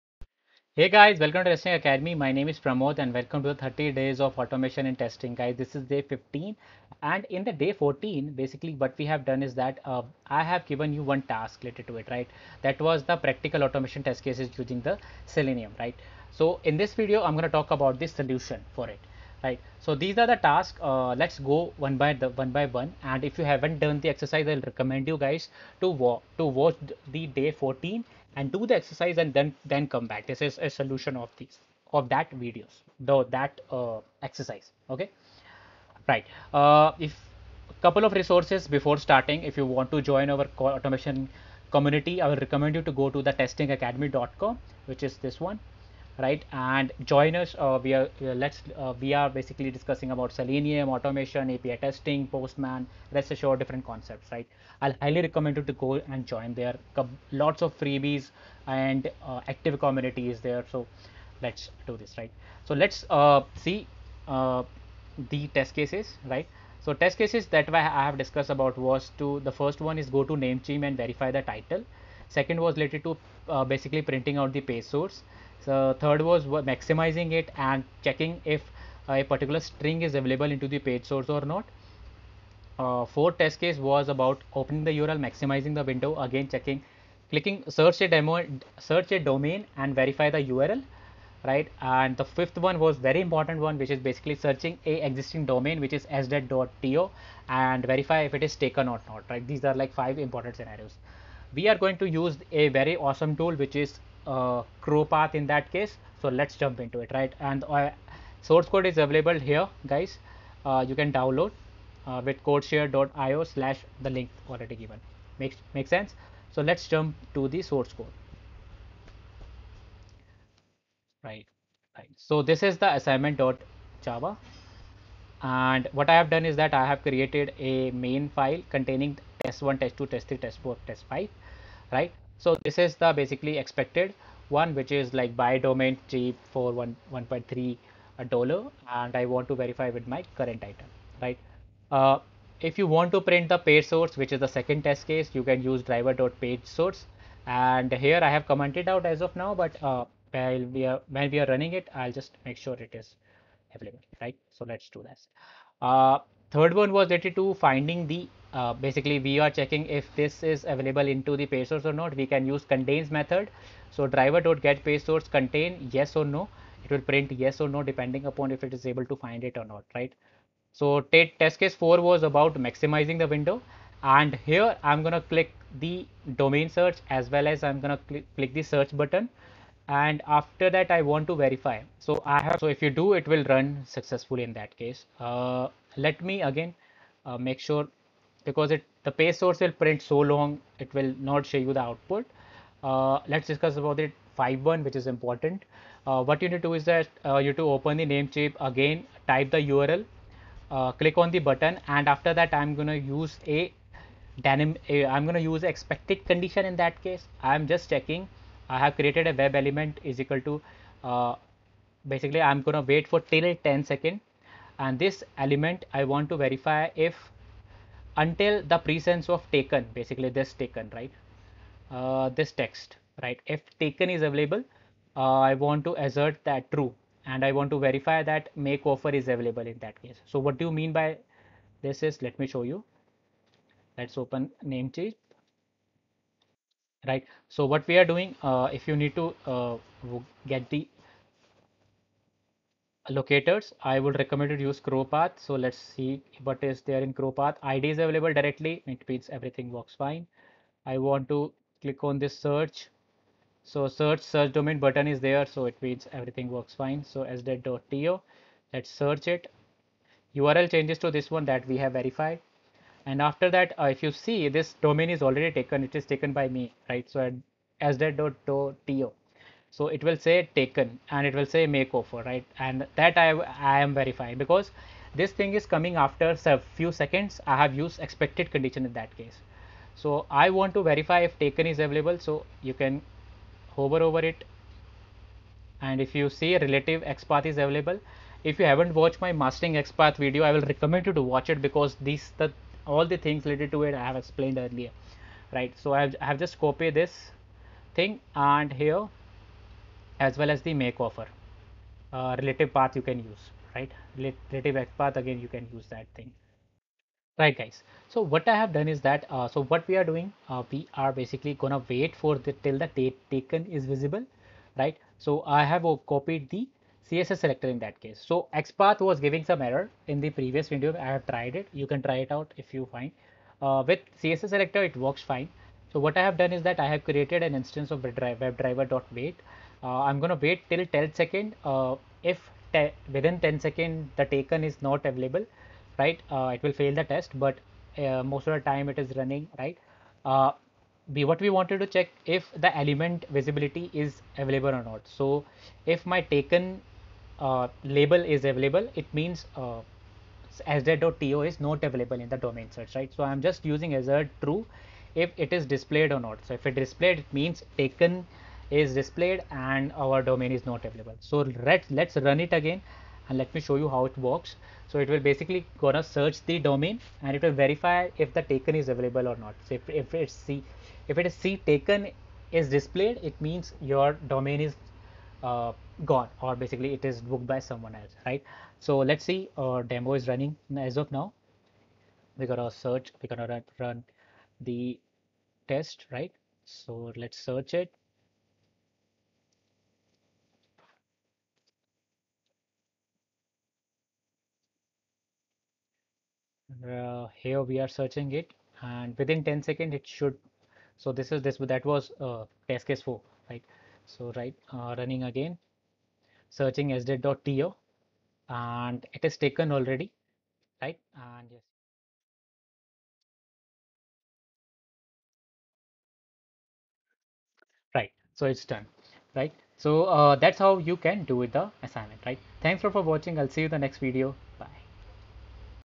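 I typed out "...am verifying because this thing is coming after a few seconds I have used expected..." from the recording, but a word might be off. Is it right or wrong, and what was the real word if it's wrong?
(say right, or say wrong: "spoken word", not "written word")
right.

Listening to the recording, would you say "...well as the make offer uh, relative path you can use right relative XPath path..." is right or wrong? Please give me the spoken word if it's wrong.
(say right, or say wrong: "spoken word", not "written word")
right.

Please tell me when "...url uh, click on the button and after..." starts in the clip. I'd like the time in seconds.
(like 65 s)
199 s.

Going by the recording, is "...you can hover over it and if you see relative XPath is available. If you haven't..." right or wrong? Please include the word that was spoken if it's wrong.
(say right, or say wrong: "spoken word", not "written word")
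right.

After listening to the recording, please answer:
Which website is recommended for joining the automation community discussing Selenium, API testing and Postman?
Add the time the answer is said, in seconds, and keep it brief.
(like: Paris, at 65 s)
testingacademy.com, at 43 s.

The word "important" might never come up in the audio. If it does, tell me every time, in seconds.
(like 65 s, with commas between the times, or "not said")
93 s, 100 s, 195 s.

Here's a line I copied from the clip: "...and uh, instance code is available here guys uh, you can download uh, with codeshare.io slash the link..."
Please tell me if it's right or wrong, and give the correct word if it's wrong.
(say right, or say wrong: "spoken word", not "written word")
wrong: "source", not "instance".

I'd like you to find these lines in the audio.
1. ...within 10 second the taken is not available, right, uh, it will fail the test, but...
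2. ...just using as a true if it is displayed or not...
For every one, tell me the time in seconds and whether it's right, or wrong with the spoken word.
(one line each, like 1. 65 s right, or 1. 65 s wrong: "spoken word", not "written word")
1. 333 s right
2. 353 s right.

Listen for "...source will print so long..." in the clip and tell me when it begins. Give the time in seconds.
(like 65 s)
189 s.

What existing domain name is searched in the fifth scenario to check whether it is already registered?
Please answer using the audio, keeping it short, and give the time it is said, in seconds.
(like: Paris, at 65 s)
sdet.to, at 96 s.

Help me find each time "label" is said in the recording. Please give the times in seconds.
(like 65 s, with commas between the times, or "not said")
347 s.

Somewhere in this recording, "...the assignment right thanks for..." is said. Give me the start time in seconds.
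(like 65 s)
421 s.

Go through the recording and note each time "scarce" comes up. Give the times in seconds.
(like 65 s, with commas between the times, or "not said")
not said.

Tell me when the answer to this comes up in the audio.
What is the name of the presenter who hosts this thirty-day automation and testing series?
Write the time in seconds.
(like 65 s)
2 s.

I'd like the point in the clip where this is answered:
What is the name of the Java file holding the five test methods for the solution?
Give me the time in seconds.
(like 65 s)
122 s.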